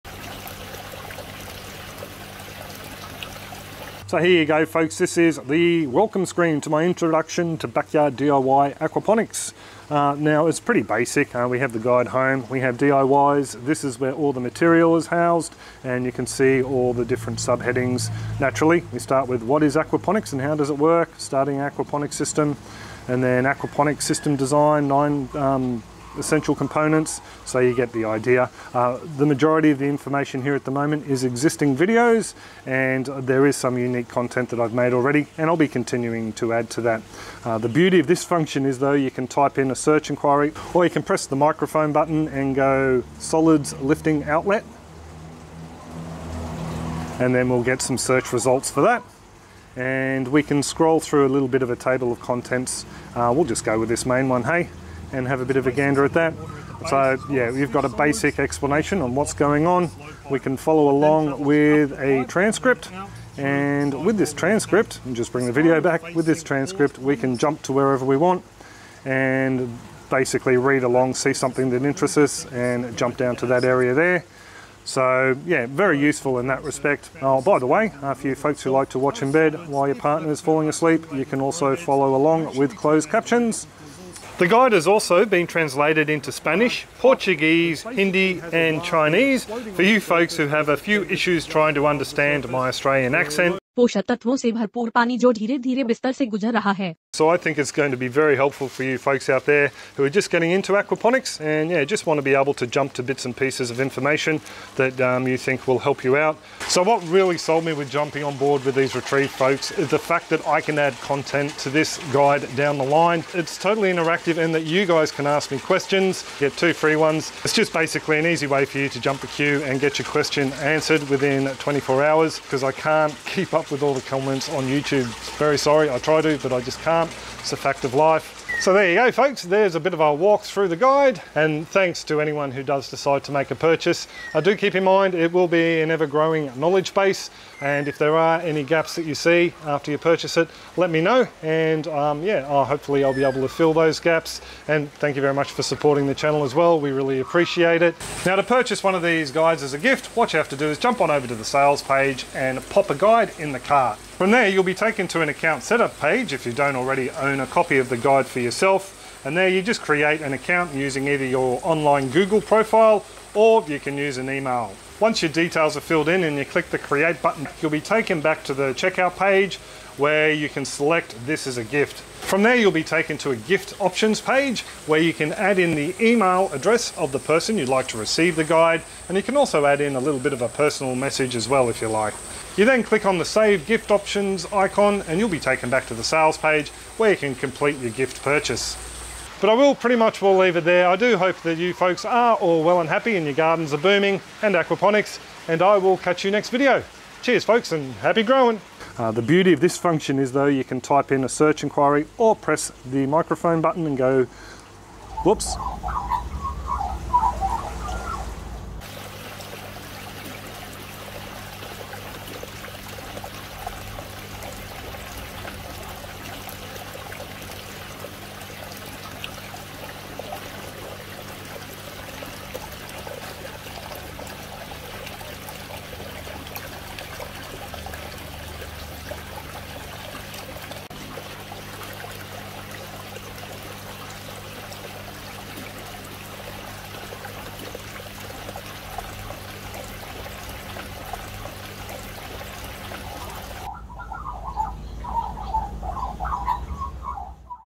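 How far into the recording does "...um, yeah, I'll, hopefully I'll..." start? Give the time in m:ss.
2:21.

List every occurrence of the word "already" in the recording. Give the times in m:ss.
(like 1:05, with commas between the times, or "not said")
0:34, 2:36.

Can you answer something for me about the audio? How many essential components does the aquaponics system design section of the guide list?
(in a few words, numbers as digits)
9.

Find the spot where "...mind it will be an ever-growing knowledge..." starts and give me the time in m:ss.
2:14.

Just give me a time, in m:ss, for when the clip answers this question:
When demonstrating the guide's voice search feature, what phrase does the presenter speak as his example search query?
0:43.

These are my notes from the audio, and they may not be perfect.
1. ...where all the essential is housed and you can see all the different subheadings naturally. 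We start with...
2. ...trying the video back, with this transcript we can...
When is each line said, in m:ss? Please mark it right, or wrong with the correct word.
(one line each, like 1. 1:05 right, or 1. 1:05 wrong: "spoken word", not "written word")
1. 0:14 wrong: "material", not "essential"
2. 1:05 wrong: "bring", not "trying".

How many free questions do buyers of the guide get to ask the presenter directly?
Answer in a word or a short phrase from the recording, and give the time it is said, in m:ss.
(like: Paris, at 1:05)
2, at 1:56.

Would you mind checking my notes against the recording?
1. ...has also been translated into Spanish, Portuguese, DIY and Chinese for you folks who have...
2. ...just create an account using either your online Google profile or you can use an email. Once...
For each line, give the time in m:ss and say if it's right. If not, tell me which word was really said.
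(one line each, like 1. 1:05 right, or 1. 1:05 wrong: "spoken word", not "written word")
1. 1:24 wrong: "Hindi", not "DIY"
2. 2:39 right.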